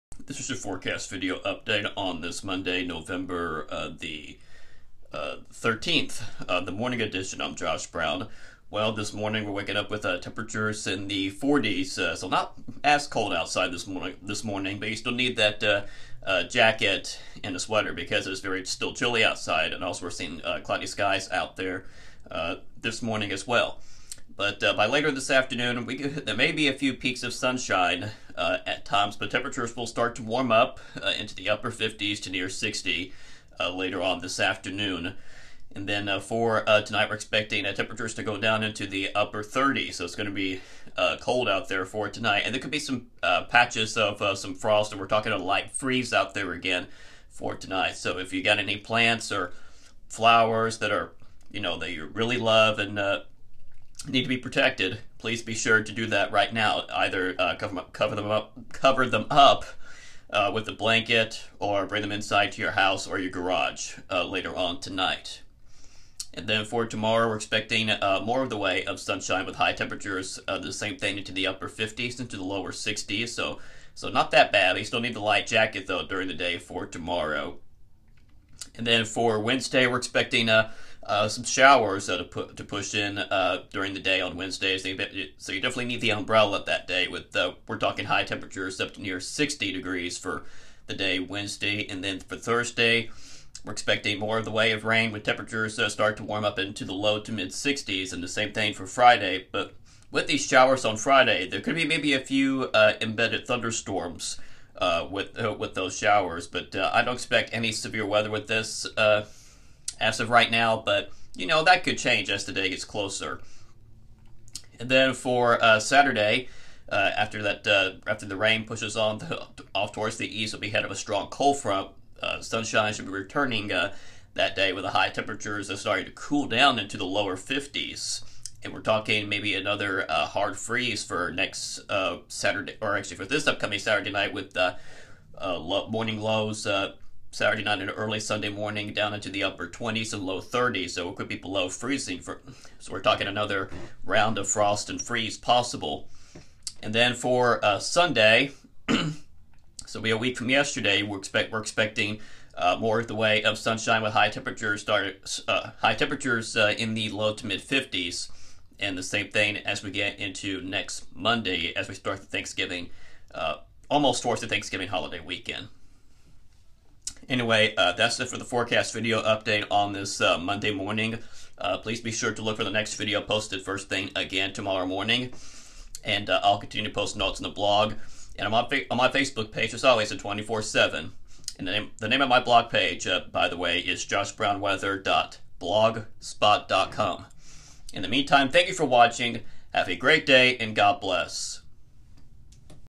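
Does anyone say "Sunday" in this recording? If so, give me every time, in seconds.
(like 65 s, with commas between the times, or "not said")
138 s, 147 s.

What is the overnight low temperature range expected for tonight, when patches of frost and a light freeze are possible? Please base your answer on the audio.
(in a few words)
upper 30s.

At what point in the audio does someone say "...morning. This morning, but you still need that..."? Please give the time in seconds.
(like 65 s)
13 s.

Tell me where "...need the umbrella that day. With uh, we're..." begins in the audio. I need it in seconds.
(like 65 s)
85 s.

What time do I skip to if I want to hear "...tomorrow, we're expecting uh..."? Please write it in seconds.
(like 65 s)
66 s.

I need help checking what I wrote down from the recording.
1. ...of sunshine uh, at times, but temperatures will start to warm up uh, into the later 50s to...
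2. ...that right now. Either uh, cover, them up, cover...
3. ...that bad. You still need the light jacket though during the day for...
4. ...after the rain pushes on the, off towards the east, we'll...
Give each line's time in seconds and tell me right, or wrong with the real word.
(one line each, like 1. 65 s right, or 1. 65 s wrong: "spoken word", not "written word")
1. 27 s wrong: "upper", not "later"
2. 56 s right
3. 74 s right
4. 118 s right.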